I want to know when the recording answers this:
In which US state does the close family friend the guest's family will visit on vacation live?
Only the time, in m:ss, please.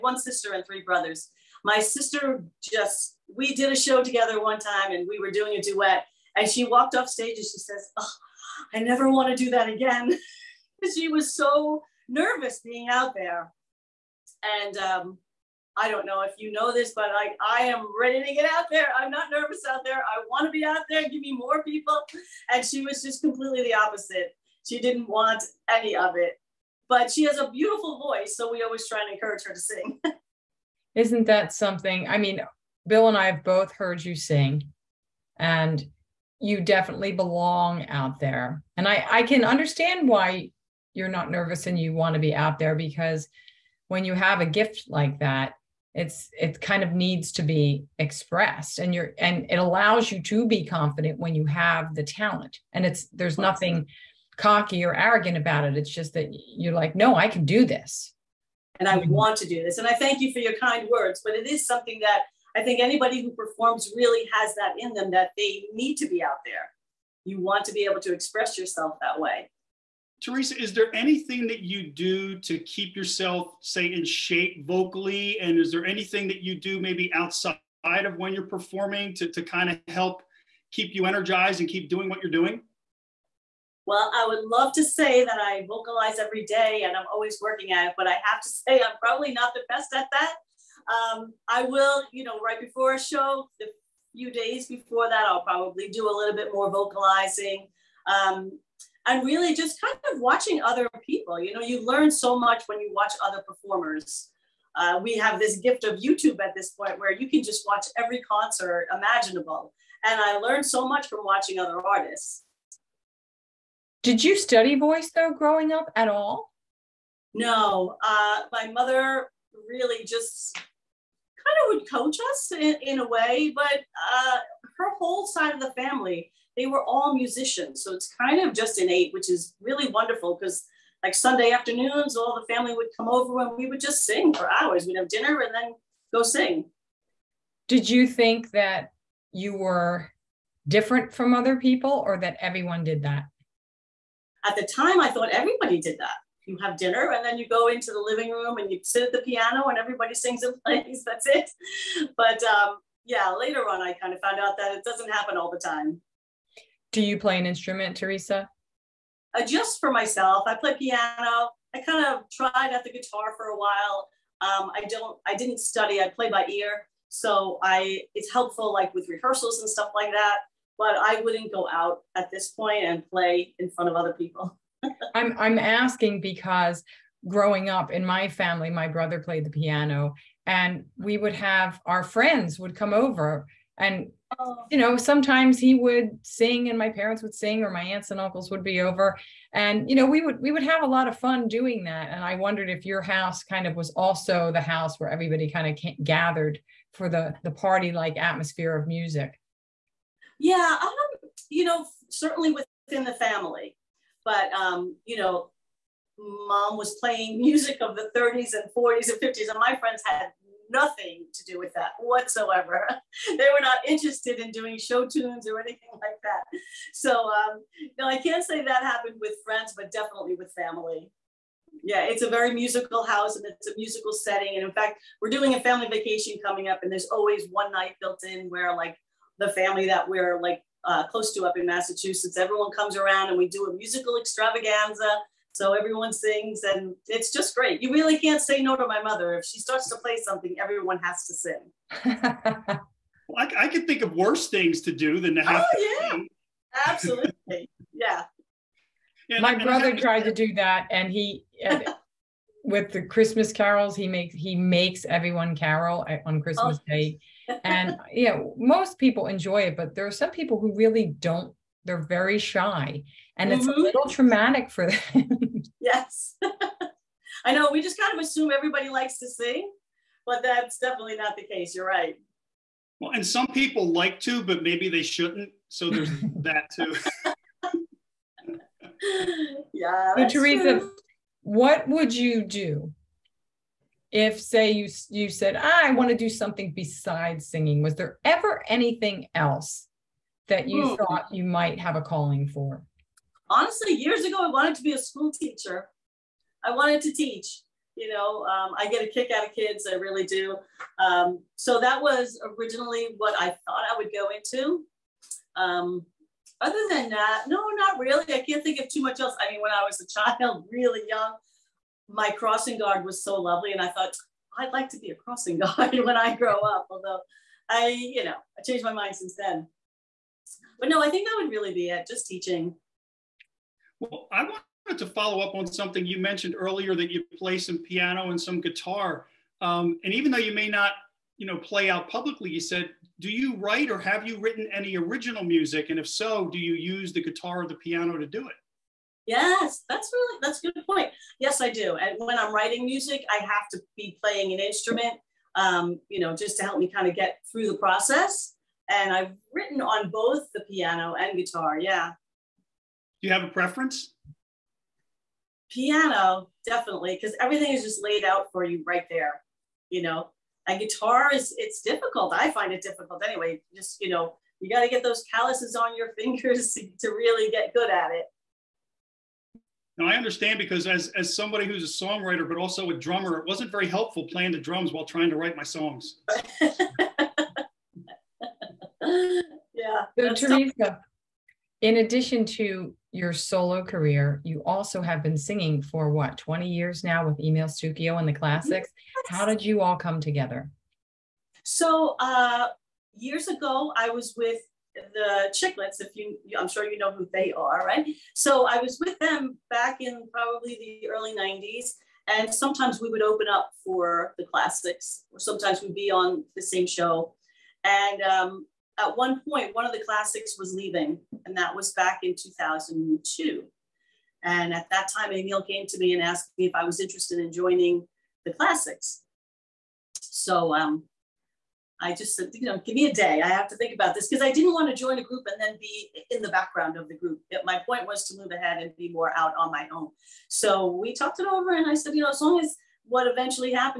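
3:51.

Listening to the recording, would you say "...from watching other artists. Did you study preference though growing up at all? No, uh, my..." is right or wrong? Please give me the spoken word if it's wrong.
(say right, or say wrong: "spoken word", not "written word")
wrong: "voice", not "preference".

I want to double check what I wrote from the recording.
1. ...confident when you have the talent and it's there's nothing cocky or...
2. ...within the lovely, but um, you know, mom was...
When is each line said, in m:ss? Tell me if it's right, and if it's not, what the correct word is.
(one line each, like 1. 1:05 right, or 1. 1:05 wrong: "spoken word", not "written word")
1. 0:50 right
2. 3:22 wrong: "family", not "lovely".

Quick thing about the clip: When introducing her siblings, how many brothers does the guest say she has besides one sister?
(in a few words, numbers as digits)
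3.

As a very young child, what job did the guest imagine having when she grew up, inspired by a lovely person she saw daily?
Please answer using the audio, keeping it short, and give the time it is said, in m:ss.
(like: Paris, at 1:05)
Crossing guard, at 5:12.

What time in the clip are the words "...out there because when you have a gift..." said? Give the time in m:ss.
0:42.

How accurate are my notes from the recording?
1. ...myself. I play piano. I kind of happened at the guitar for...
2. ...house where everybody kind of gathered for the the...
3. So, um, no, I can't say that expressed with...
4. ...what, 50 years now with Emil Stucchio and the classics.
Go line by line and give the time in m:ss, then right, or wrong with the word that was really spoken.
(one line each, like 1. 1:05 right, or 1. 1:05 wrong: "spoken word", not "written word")
1. 2:39 wrong: "tried", not "happened"
2. 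3:14 right
3. 3:36 wrong: "happened", not "expressed"
4. 6:26 wrong: "20", not "50".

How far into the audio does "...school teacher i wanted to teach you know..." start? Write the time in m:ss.
4:54.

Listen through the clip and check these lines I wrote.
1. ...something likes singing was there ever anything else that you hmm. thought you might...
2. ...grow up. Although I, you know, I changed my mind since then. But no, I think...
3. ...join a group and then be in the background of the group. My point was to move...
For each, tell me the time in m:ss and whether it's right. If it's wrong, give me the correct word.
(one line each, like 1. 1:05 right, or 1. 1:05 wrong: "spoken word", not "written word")
1. 4:46 wrong: "besides", not "likes"
2. 5:16 right
3. 7:05 right.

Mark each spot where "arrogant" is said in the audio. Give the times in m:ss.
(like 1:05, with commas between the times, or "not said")
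0:54.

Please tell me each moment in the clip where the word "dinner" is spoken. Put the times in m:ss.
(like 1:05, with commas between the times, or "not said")
2:15, 2:26.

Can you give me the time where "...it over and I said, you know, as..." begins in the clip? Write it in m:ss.
7:11.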